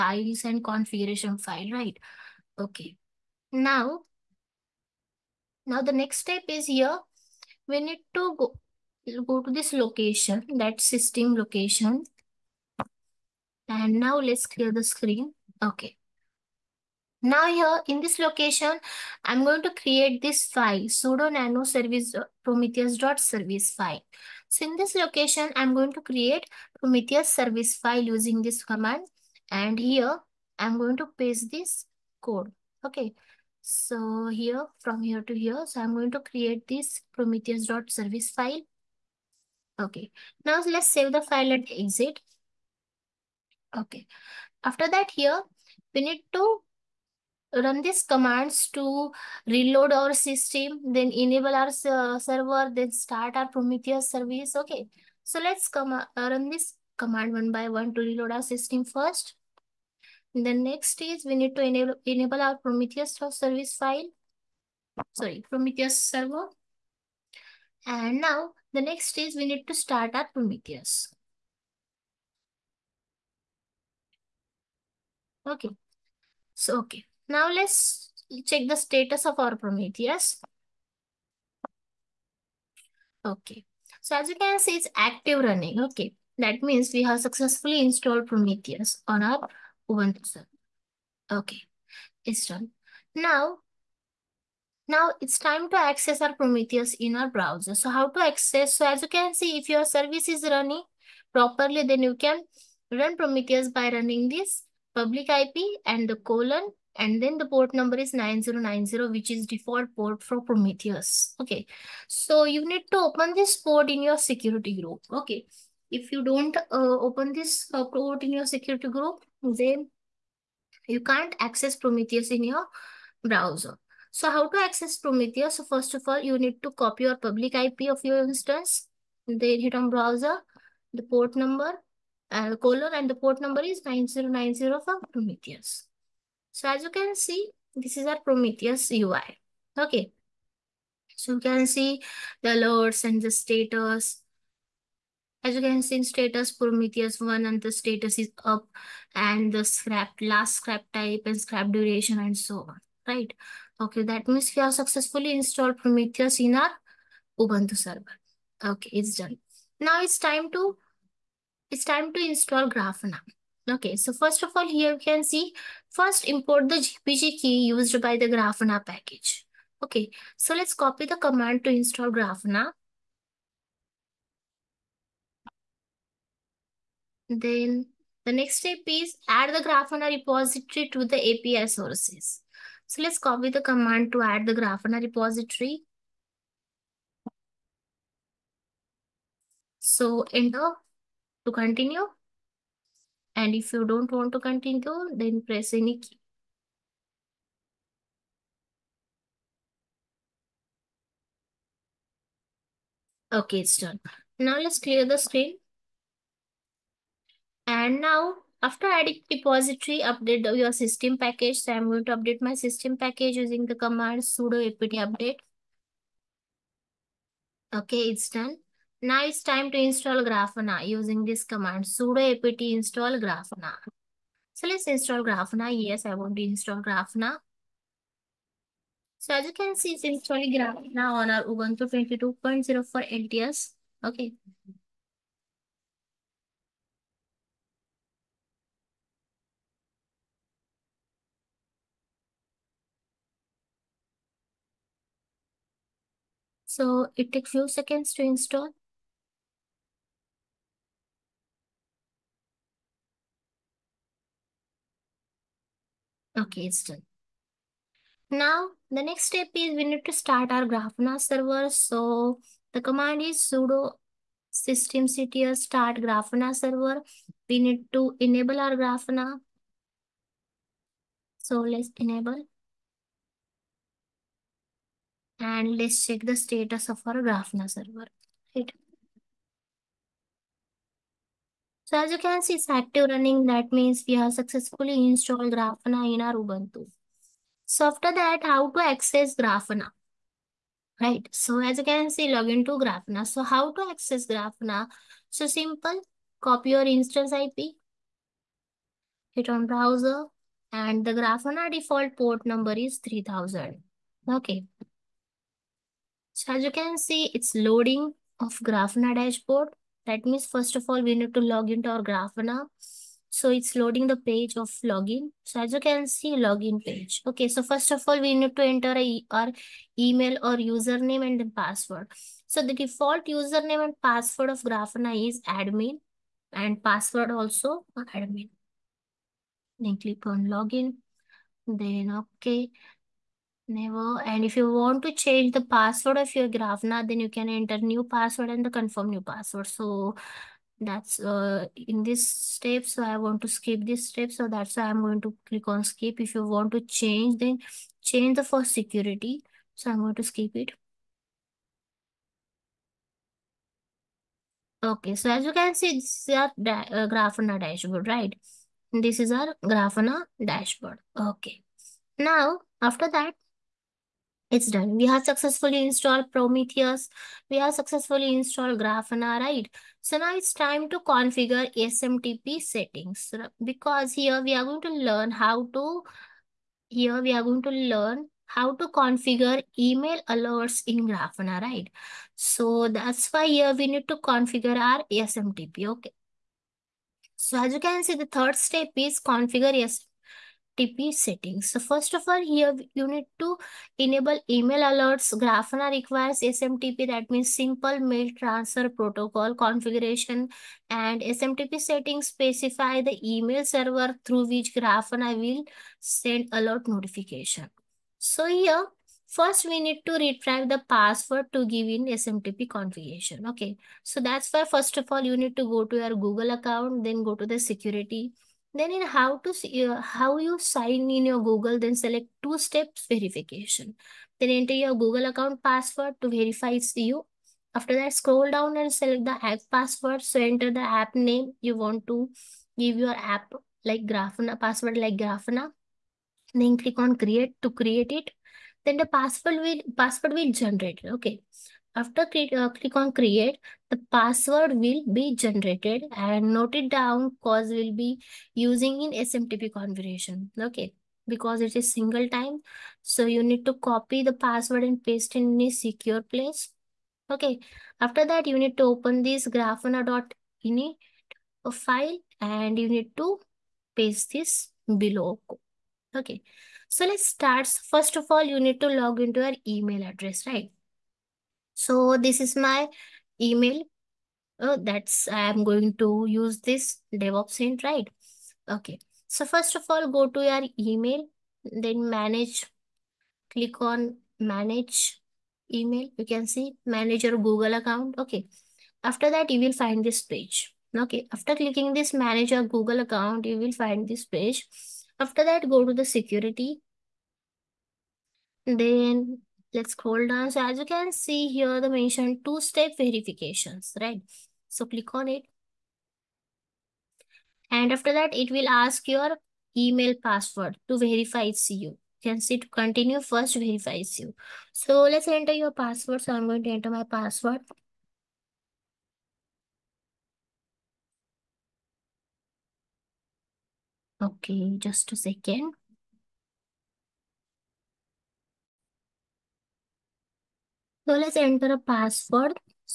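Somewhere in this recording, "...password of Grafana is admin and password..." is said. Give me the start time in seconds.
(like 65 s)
324 s.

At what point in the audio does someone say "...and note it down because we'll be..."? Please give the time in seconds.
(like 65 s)
446 s.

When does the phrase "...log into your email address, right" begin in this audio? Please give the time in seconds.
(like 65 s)
468 s.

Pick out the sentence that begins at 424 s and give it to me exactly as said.
Then enter your Google account password to verify you.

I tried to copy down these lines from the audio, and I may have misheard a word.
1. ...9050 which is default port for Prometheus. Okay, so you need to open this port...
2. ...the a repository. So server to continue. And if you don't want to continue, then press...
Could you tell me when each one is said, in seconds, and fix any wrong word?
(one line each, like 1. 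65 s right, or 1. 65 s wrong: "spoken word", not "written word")
1. 108 s wrong: "9090", not "9050"
2. 184 s wrong: "enter", not "server".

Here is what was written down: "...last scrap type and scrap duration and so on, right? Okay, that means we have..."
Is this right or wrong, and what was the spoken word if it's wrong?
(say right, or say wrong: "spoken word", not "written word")
right.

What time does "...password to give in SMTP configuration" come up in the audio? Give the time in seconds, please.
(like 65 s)
410 s.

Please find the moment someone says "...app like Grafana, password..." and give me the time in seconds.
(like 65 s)
433 s.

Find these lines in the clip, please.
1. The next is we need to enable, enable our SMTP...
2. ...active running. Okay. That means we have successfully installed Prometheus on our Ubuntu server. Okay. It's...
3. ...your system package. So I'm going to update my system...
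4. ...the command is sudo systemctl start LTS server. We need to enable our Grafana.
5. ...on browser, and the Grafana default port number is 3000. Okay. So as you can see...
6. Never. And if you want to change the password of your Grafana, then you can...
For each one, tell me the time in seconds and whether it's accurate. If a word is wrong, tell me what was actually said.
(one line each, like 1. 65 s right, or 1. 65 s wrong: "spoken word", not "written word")
1. 60 s wrong: "Prometheus", not "SMTP"
2. 84 s right
3. 210 s right
4. 262 s wrong: "Grafana", not "LTS"
5. 299 s right
6. 333 s right.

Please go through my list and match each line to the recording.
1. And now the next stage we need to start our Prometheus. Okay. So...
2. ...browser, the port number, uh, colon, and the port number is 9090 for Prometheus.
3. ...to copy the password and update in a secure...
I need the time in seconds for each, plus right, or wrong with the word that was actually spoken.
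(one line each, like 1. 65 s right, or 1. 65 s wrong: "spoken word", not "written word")
1. 67 s right
2. 129 s right
3. 453 s wrong: "paste", not "update".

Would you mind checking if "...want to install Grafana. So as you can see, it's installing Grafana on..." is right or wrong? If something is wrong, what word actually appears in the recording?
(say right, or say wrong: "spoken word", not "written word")
right.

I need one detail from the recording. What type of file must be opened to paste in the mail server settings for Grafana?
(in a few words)
ini file.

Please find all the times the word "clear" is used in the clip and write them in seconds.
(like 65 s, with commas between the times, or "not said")
14 s, 204 s.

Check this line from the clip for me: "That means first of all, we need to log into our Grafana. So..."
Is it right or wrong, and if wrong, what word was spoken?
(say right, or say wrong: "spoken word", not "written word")
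right.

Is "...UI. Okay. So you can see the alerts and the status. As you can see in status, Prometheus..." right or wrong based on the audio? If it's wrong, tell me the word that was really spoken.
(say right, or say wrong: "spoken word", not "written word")
right.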